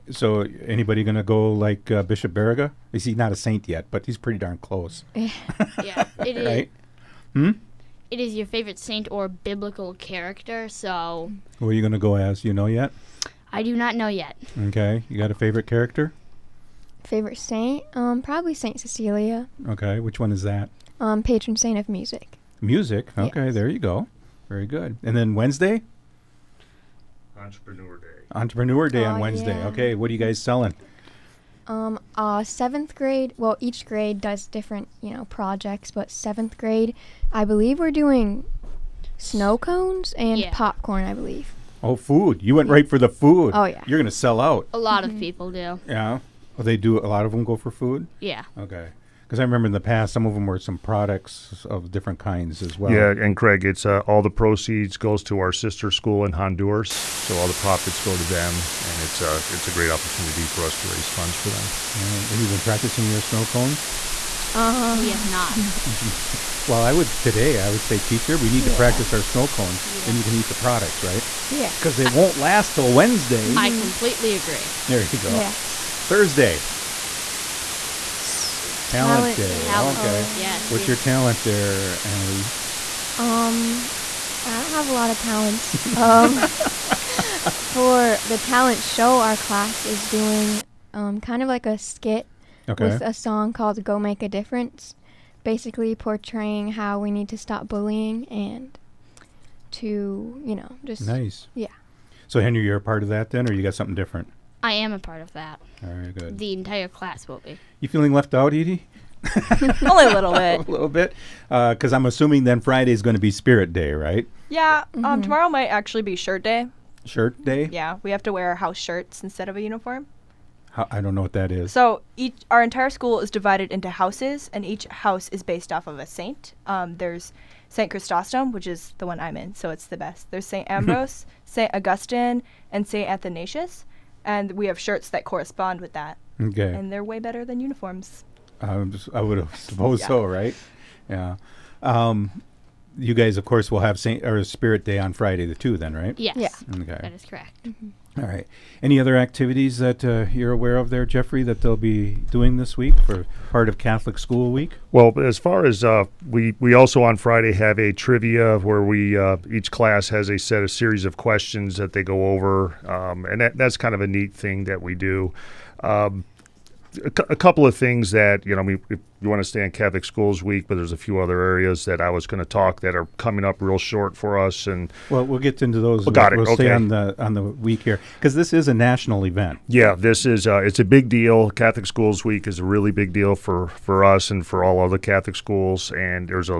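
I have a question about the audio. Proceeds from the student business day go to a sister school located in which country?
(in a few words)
Honduras.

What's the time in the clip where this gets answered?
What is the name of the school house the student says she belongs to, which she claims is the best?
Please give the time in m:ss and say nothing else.
2:07.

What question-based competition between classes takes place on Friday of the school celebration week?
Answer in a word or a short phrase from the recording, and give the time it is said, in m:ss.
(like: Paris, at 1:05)
Trivia, at 2:37.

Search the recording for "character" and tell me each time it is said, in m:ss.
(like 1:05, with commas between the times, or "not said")
0:09, 0:15.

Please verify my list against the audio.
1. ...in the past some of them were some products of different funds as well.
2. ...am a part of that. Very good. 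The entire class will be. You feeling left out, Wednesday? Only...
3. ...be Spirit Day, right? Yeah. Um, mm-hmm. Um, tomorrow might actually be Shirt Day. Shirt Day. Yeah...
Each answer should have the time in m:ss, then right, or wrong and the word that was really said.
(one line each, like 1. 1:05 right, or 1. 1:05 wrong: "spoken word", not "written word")
1. 0:49 wrong: "kinds", not "funds"
2. 1:44 wrong: "Edie", not "Wednesday"
3. 1:53 right.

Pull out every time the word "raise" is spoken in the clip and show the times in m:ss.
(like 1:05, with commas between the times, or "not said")
1:00.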